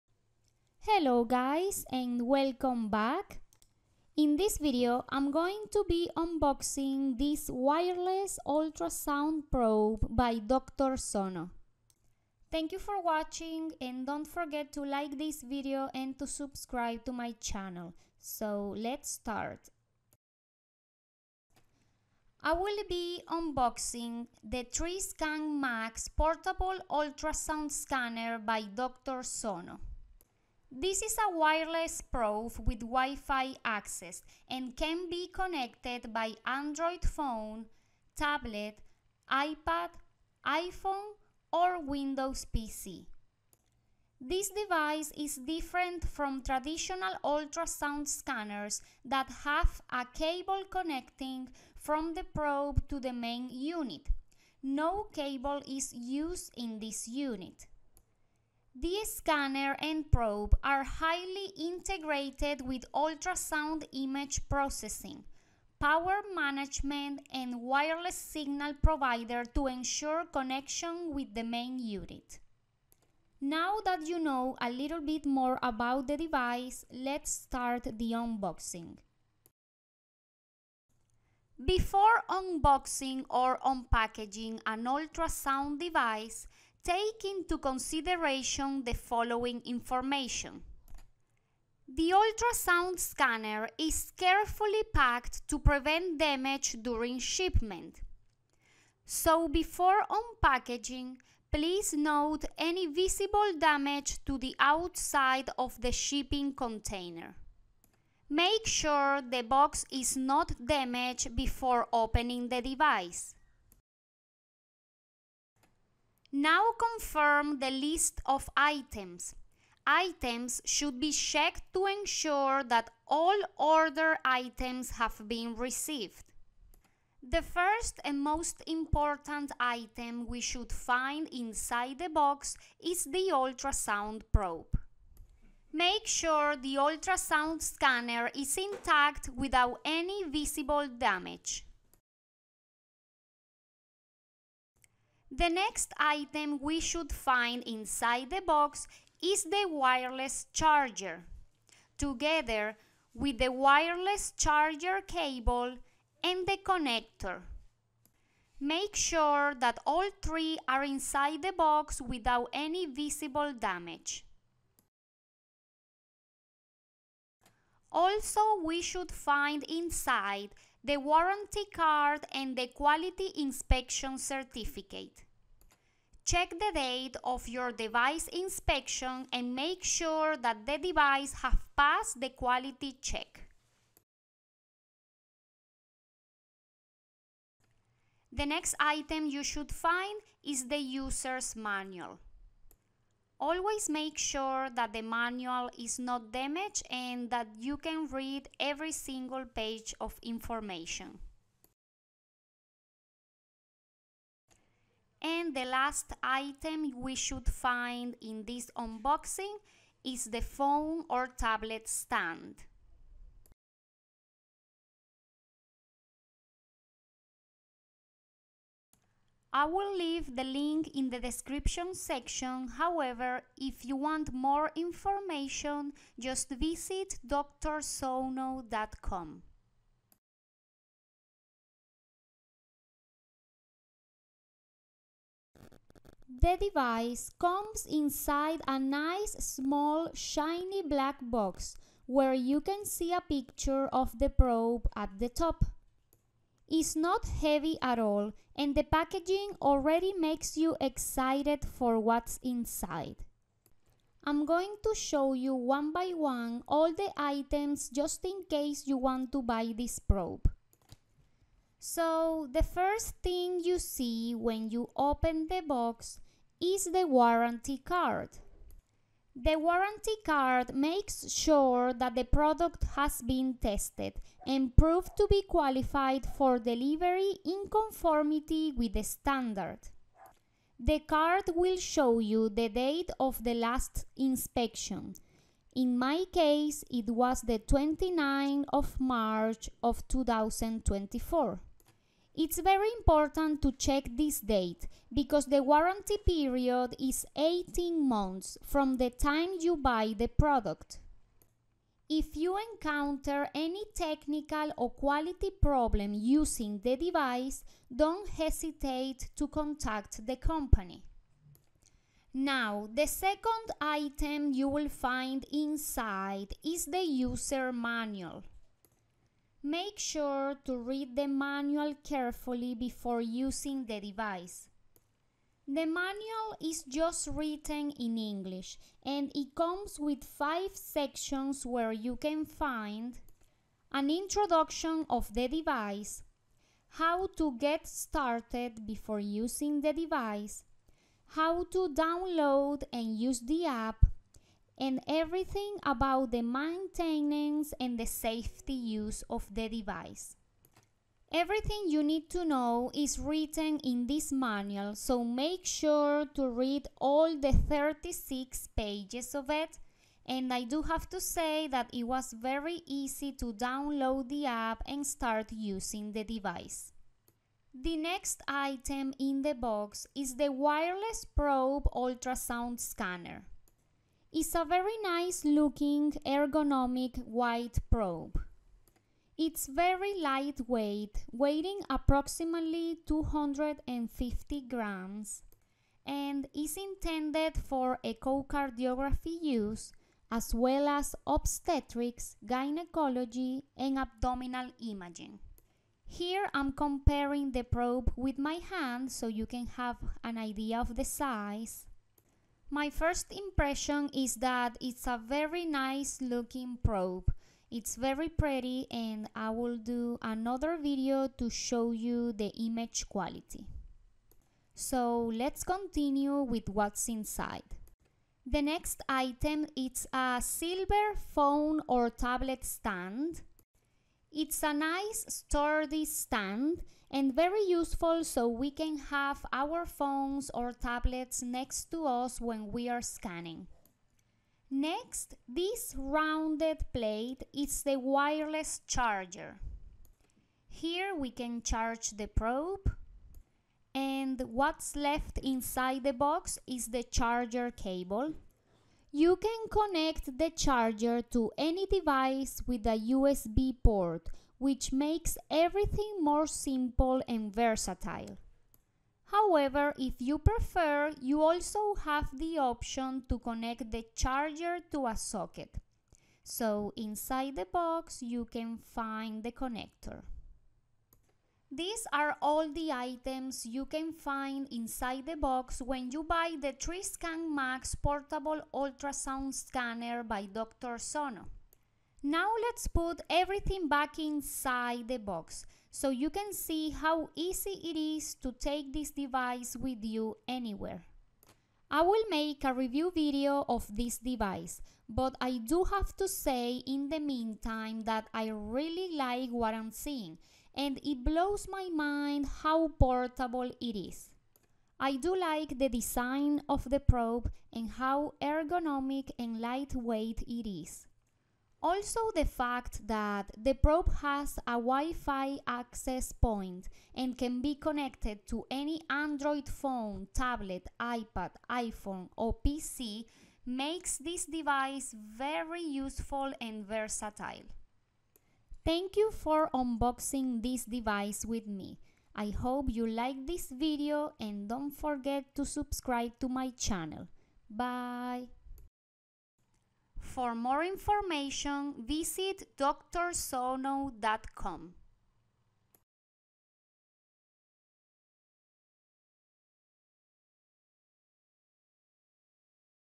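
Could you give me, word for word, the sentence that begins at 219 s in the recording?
I will leave the link in the description section, however, if you want more information, just visit drsono.com.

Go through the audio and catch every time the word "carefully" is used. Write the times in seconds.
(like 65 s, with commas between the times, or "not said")
94 s, 322 s.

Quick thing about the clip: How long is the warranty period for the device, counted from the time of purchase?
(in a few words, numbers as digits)
18 months.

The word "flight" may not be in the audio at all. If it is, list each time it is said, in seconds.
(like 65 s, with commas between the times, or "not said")
not said.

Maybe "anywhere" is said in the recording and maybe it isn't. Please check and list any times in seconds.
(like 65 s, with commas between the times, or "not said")
490 s.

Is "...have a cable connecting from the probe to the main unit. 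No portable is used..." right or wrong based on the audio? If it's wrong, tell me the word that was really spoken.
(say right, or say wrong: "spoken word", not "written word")
wrong: "cable", not "portable".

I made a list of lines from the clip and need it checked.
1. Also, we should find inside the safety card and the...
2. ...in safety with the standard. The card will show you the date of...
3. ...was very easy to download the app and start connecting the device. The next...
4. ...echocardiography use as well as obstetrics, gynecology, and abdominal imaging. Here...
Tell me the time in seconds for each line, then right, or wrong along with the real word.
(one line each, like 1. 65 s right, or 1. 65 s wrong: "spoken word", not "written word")
1. 167 s wrong: "warranty", not "safety"
2. 277 s wrong: "conformity", not "safety"
3. 362 s wrong: "using", not "connecting"
4. 388 s right.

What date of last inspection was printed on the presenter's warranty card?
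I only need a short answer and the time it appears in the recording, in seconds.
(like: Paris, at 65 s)
29 March 2024, at 287 s.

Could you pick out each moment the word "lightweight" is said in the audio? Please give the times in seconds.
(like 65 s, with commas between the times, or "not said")
380 s, 509 s.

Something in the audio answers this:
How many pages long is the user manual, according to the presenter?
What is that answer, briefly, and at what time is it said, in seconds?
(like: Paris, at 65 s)
36, at 357 s.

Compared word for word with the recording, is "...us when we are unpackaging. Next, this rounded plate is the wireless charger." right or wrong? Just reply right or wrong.
wrong.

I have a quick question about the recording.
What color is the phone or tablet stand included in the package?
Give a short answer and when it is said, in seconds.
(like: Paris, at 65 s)
Silver, at 420 s.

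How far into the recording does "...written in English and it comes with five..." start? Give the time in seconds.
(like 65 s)
327 s.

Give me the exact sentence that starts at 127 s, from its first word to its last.
The first and most important item we should find inside the box is the ultrasound probe.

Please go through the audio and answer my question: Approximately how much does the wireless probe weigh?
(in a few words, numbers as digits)
250 grams.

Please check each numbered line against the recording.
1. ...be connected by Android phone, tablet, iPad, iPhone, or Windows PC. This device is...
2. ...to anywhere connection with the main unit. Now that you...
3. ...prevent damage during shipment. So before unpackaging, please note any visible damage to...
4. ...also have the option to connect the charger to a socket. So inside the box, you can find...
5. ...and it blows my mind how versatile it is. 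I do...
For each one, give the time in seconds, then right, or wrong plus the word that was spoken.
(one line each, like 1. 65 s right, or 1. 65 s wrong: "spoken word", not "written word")
1. 35 s right
2. 69 s wrong: "ensure", not "anywhere"
3. 95 s right
4. 461 s right
5. 500 s wrong: "portable", not "versatile".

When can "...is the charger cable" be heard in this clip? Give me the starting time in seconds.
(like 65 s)
446 s.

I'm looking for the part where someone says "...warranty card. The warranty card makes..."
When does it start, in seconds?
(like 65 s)
267 s.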